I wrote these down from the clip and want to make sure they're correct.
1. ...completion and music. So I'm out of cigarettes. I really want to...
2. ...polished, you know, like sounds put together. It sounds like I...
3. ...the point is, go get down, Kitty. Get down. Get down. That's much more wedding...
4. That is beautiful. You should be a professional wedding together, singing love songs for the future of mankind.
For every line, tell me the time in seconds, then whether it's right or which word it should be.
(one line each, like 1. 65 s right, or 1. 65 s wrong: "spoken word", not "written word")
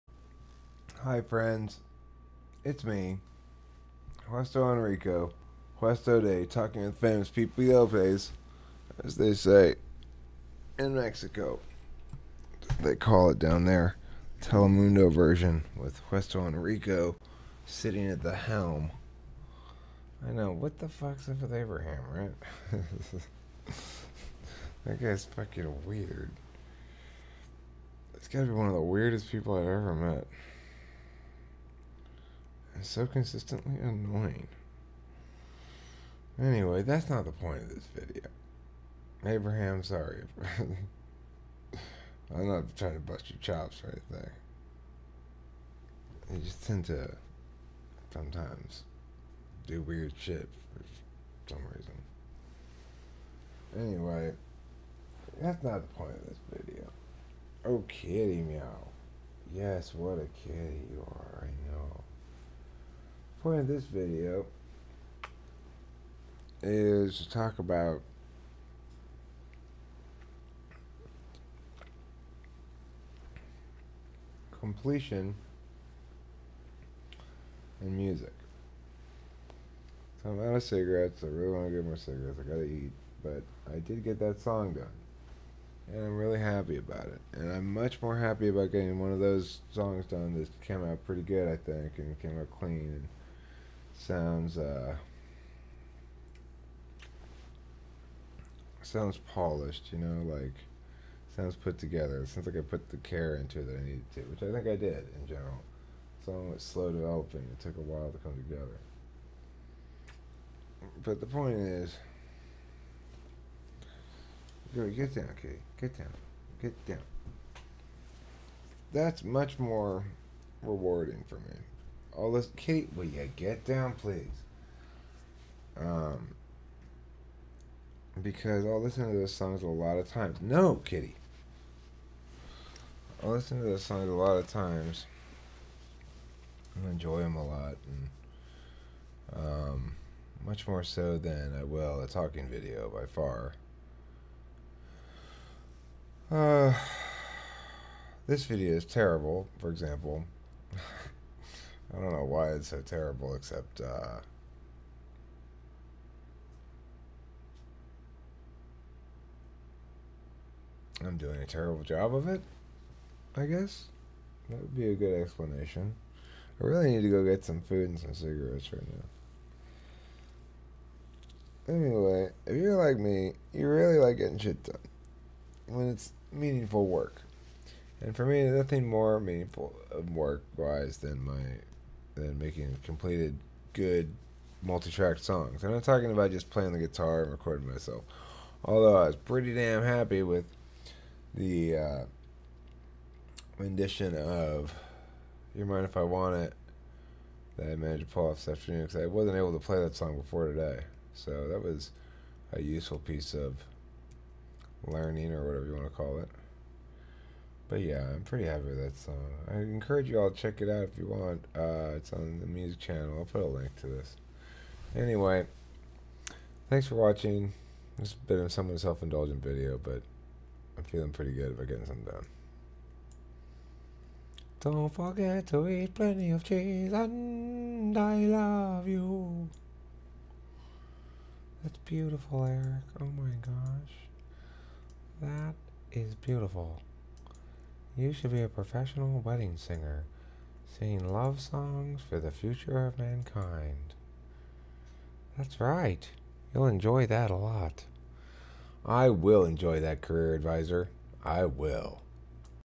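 1. 74 s right
2. 99 s right
3. 111 s wrong: "rewarding", not "wedding"
4. 235 s wrong: "singer", not "together".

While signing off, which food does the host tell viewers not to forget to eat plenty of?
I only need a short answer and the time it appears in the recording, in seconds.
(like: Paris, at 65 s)
cheese, at 226 s.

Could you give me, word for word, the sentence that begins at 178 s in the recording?
And for me, nothing more meaningful work wise than my than making completed good multi-track songs.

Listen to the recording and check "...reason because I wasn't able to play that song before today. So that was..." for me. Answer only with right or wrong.
wrong.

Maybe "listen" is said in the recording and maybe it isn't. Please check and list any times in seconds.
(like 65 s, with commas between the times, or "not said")
128 s, 133 s.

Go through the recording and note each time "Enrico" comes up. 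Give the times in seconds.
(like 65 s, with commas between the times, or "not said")
4 s, 16 s.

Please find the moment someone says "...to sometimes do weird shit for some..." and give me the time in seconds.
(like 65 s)
46 s.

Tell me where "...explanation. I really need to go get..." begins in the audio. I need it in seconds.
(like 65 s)
165 s.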